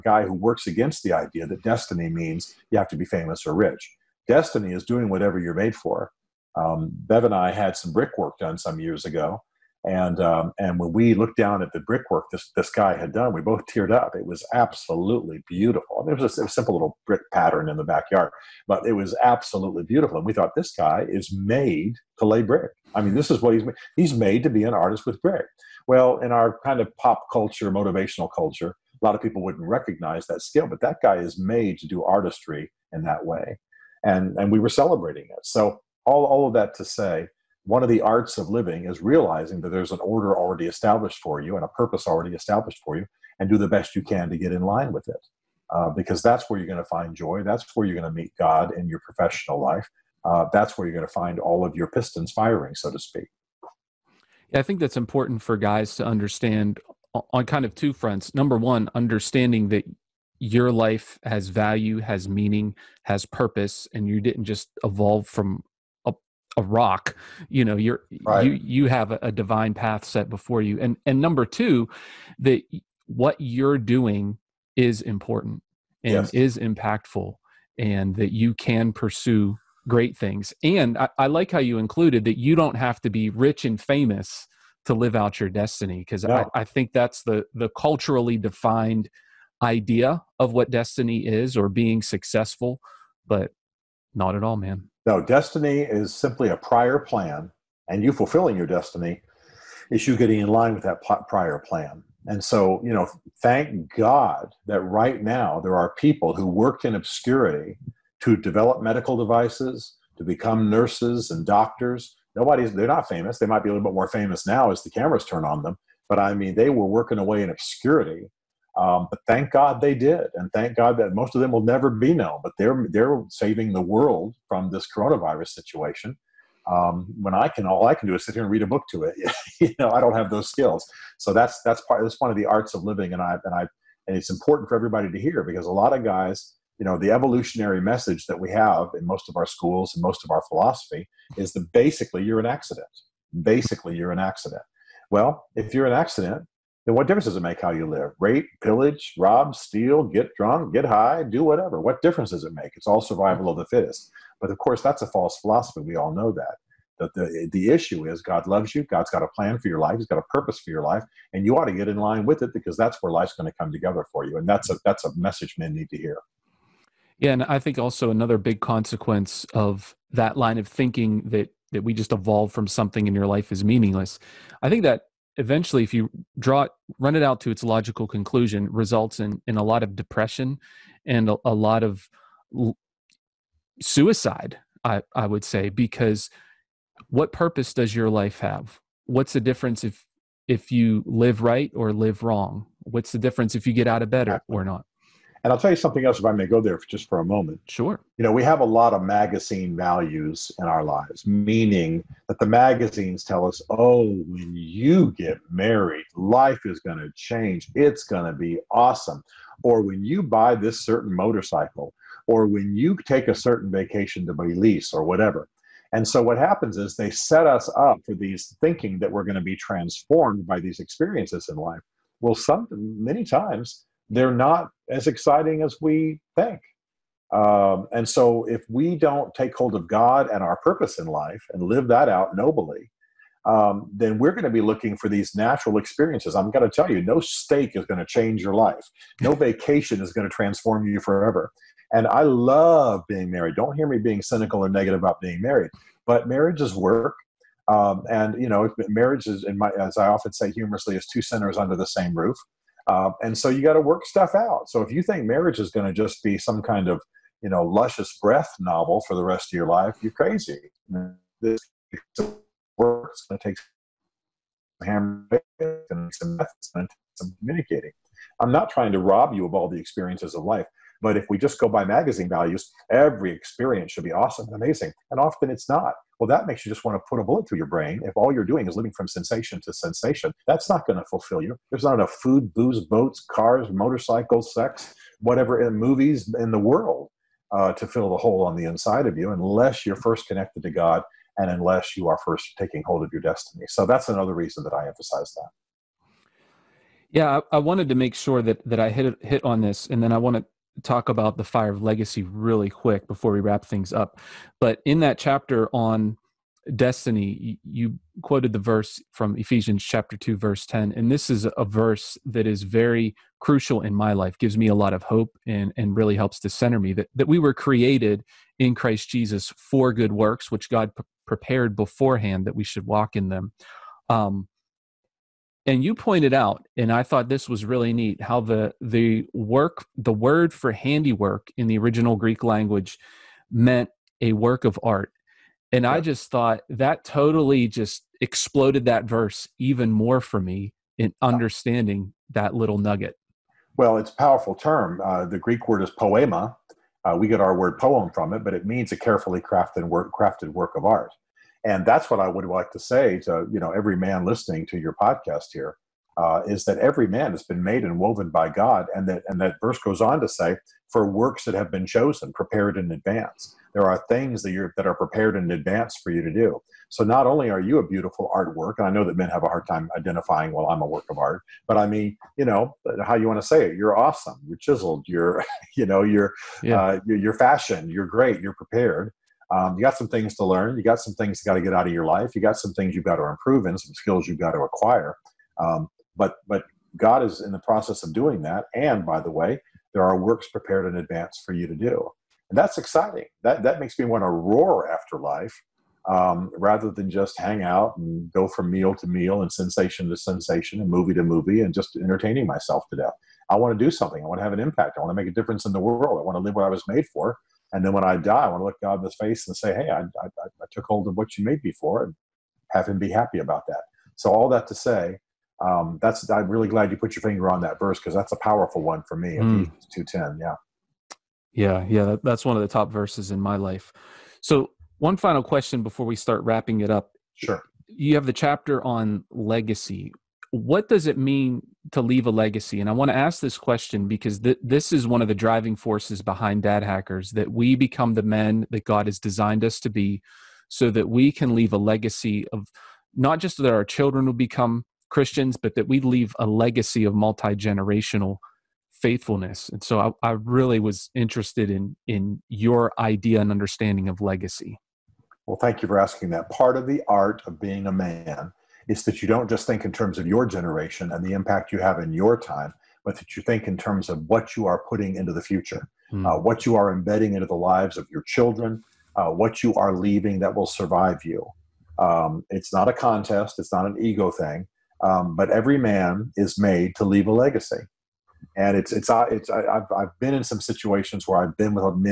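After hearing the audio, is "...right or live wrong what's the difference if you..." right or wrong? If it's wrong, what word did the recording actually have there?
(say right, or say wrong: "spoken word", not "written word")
right.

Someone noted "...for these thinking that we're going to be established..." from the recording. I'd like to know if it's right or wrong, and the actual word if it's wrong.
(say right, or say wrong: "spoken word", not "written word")
wrong: "transformed", not "established".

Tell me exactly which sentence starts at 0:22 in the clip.
I mean, this is what he's made.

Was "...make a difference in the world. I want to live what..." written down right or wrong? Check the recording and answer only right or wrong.
right.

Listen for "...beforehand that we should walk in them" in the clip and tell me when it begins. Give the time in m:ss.
5:21.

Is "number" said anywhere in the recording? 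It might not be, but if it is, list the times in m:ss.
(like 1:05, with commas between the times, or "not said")
0:58, 1:11.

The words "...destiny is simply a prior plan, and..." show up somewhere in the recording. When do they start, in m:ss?
1:35.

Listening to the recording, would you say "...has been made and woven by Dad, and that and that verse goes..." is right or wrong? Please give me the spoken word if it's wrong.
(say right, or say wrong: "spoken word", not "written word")
wrong: "God", not "Dad".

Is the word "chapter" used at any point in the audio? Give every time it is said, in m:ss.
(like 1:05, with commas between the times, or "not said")
5:05, 5:09, 7:08.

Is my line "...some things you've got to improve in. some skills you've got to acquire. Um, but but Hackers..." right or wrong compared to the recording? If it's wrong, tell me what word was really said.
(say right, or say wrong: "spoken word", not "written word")
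wrong: "God", not "Hackers".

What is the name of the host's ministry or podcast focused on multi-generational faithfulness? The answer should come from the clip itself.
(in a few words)
Dad Hackers.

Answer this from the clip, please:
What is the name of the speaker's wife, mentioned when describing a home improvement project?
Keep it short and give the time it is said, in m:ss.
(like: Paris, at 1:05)
Bev, at 0:06.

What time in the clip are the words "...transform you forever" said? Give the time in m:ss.
4:00.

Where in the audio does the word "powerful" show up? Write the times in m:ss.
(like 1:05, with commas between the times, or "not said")
5:44, 6:58.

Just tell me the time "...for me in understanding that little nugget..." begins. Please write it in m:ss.
5:40.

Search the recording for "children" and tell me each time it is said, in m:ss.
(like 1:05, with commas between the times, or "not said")
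7:23, 7:48.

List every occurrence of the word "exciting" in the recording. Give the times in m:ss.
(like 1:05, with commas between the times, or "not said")
3:45, 6:32.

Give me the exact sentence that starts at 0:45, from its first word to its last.
Uh, because that's where you're going to find joy.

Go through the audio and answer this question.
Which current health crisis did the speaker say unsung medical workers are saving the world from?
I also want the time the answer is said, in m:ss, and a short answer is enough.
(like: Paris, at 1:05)
Coronavirus, at 2:04.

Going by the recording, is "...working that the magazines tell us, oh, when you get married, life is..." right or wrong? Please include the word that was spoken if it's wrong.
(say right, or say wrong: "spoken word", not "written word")
wrong: "meaning", not "working".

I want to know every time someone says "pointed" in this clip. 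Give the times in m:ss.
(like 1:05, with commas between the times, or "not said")
5:25.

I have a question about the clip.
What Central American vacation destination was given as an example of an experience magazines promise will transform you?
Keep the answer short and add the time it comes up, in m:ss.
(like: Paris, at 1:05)
Belize, at 3:34.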